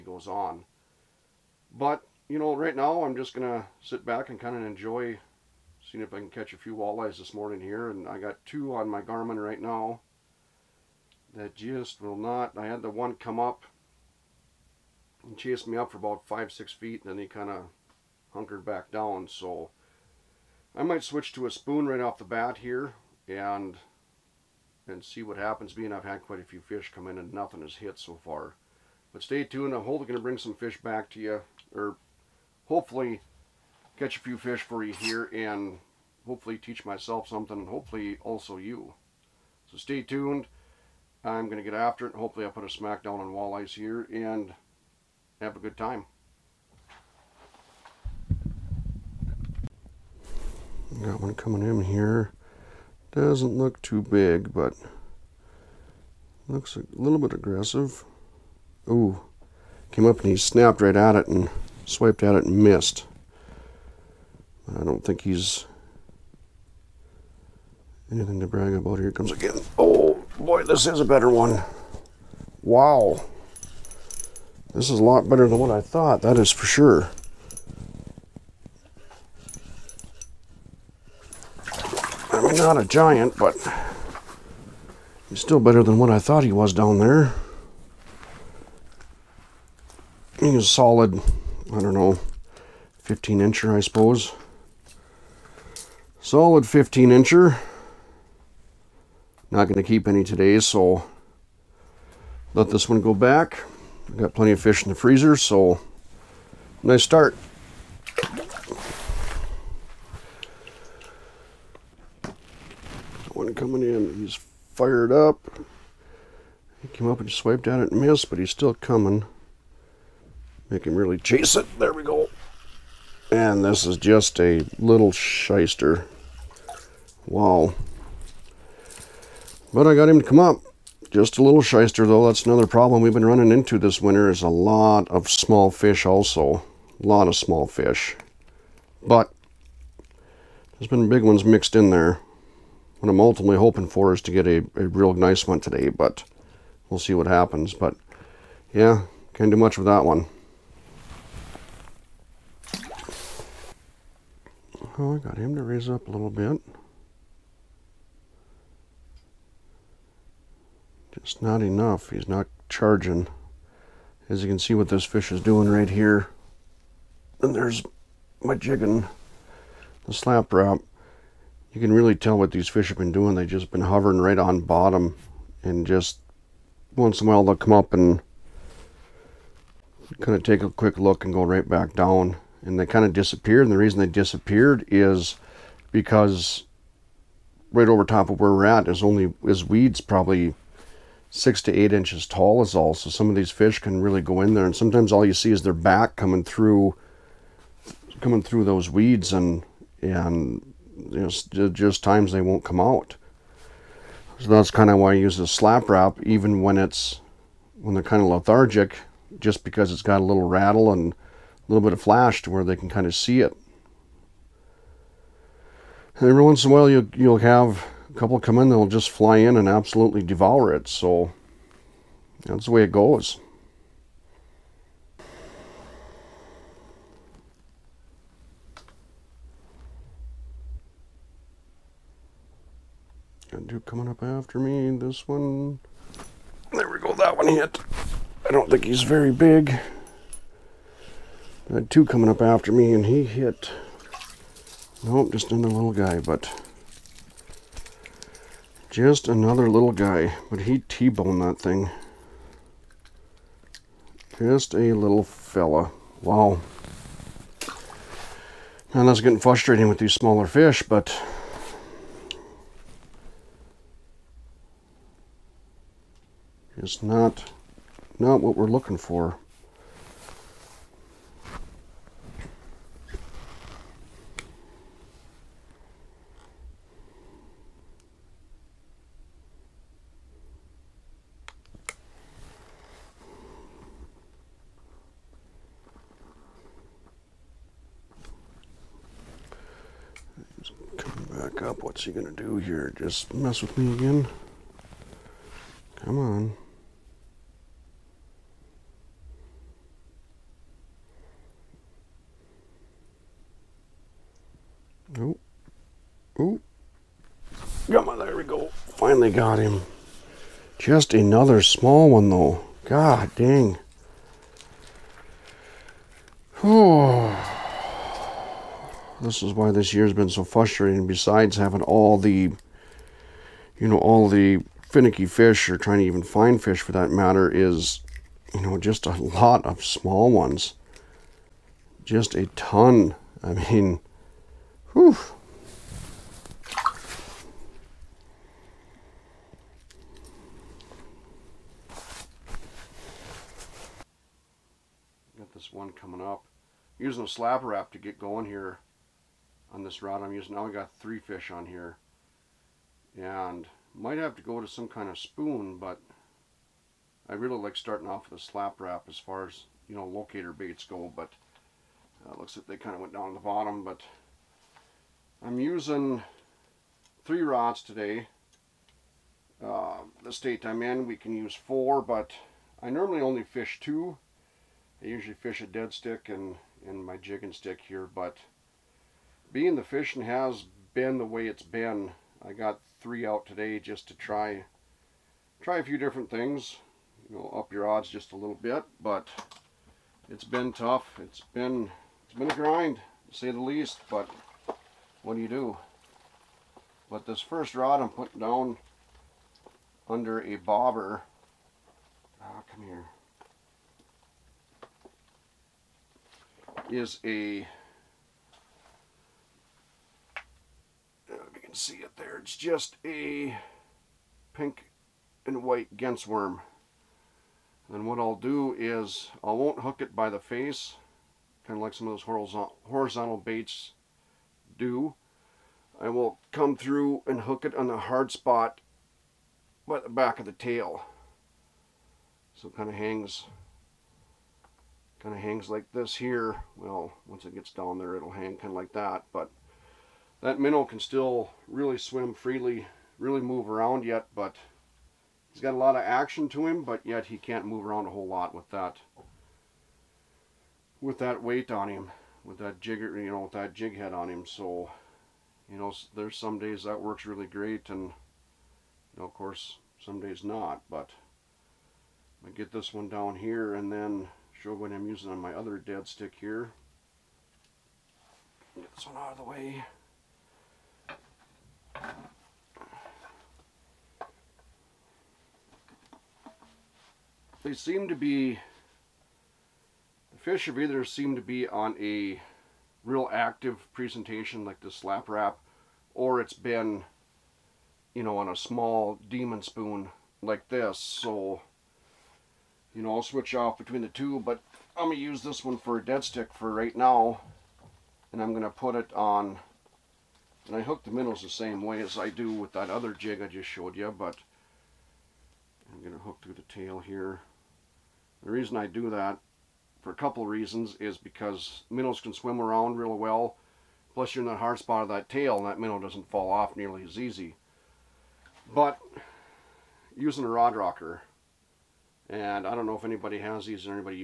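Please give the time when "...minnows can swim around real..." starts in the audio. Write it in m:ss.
8:31.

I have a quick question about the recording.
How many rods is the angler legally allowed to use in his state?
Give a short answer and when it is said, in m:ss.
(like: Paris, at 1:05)
4, at 6:11.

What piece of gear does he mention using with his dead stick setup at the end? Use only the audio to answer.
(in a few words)
rod rocker.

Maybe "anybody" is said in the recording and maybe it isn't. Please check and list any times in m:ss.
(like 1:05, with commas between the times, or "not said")
8:43.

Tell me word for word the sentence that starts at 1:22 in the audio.
not a giant, but he's still better than what I thought he was down there.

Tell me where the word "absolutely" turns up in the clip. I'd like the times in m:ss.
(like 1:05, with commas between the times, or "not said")
3:39.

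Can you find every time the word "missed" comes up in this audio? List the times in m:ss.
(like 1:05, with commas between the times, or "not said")
1:02, 1:58.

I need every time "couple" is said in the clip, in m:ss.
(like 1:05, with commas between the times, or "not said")
3:38, 8:30.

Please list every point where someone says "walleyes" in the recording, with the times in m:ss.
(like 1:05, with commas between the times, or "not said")
0:06, 0:43.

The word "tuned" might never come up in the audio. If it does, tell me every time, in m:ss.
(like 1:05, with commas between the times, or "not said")
0:29, 0:40.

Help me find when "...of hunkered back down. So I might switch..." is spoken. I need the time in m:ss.
0:17.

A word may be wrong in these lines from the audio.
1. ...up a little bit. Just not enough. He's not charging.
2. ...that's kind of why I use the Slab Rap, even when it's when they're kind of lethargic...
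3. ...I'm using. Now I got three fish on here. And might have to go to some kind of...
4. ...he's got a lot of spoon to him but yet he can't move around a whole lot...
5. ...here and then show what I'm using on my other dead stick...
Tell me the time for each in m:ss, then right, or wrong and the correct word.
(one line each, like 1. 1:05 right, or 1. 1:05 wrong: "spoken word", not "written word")
1. 2:35 right
2. 3:24 right
3. 5:50 right
4. 7:25 wrong: "action", not "spoon"
5. 7:43 right.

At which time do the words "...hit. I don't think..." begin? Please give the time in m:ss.
3:57.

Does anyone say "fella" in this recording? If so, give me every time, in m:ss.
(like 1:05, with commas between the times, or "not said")
4:15.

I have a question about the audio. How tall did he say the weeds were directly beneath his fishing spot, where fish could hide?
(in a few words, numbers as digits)
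6 to 8 inches.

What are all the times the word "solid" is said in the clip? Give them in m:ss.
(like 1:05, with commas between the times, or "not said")
1:30, 1:36.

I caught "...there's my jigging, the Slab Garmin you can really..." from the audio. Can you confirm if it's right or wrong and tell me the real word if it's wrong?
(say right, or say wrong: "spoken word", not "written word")
wrong: "Rap", not "Garmin".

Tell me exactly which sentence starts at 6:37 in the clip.
But this first rod I'm putting down under a bobber.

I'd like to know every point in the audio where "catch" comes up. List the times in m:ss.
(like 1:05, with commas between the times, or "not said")
0:06, 0:33.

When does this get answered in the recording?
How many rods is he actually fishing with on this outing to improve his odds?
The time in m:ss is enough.
6:07.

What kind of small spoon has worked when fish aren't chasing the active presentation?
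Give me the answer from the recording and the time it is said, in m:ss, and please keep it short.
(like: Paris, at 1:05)
demon spoon, at 8:09.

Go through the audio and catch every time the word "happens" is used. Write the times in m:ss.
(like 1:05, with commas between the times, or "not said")
0:25, 2:27.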